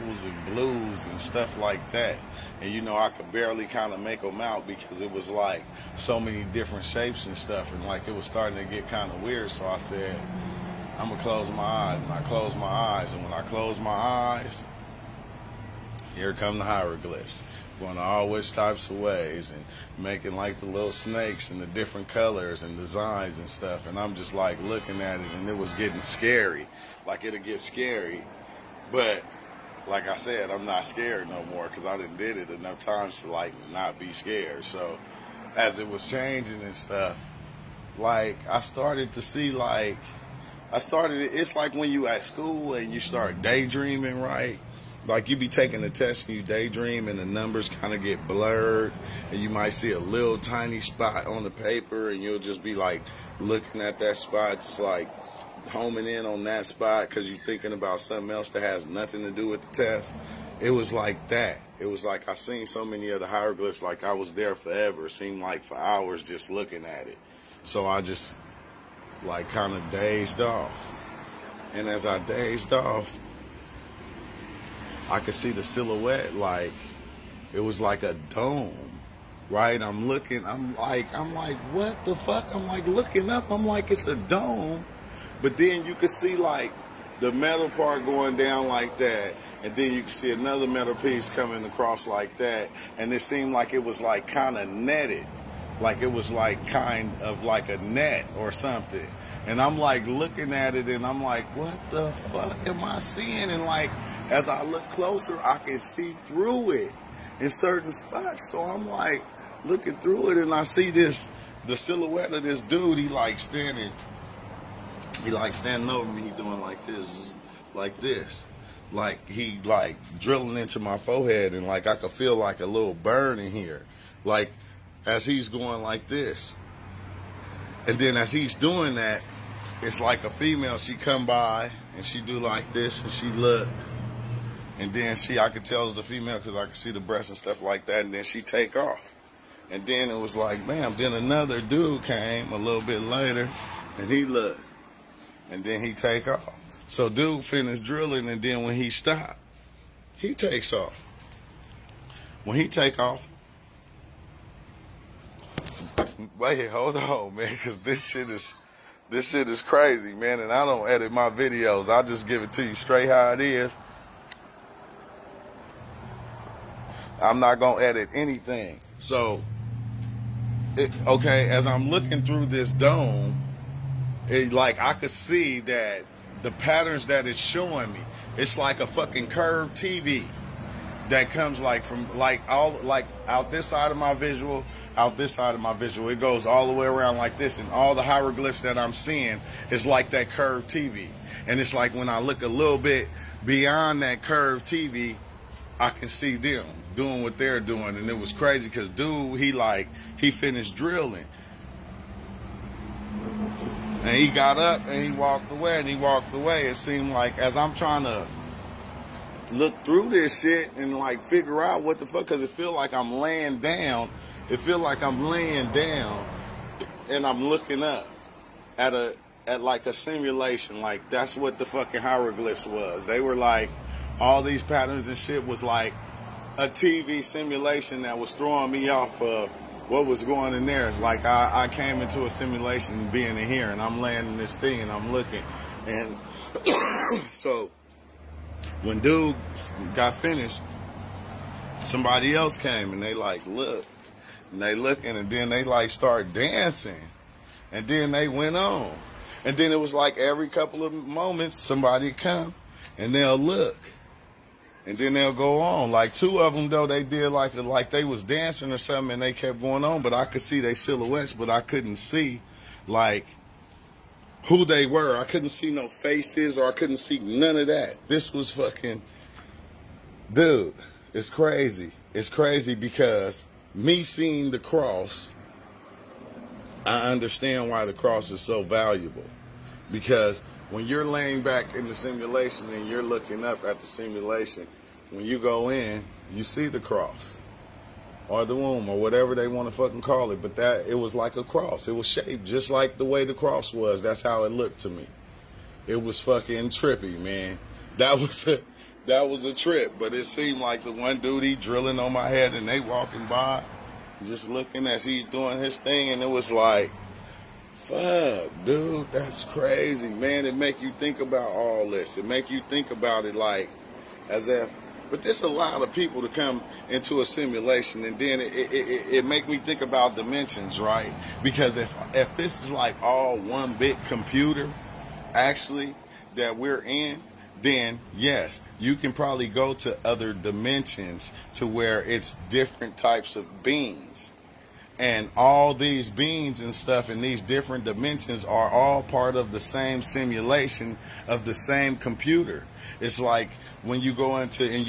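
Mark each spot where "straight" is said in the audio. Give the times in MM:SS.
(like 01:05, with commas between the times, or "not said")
02:42.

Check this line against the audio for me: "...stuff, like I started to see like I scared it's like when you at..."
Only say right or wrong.
wrong.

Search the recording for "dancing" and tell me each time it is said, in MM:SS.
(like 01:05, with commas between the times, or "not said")
04:06, 04:18.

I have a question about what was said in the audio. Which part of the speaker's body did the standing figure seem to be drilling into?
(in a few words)
forehead.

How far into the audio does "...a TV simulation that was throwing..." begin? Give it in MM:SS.
03:46.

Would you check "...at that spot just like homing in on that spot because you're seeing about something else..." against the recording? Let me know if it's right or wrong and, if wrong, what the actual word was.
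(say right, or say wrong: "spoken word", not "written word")
wrong: "thinking", not "seeing".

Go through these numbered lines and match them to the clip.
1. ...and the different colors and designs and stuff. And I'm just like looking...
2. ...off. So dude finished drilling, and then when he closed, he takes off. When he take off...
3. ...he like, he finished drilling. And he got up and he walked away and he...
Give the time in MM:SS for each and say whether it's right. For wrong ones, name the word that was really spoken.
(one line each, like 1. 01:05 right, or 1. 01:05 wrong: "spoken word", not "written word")
1. 00:21 right
2. 02:26 wrong: "stopped", not "closed"
3. 03:19 right.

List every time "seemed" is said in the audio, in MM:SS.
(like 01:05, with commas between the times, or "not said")
01:05, 01:33, 03:26, 05:00.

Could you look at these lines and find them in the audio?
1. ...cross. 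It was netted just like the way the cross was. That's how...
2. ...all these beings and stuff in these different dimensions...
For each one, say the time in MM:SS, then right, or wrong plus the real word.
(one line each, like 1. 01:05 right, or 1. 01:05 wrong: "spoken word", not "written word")
1. 04:51 wrong: "shaped", not "netted"
2. 05:35 right.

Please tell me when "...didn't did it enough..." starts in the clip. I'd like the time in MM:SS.
00:31.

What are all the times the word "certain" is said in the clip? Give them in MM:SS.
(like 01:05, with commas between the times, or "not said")
01:47.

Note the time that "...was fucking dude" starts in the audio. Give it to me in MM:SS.
04:28.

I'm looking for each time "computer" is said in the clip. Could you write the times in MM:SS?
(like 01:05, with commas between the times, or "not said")
05:24, 05:41.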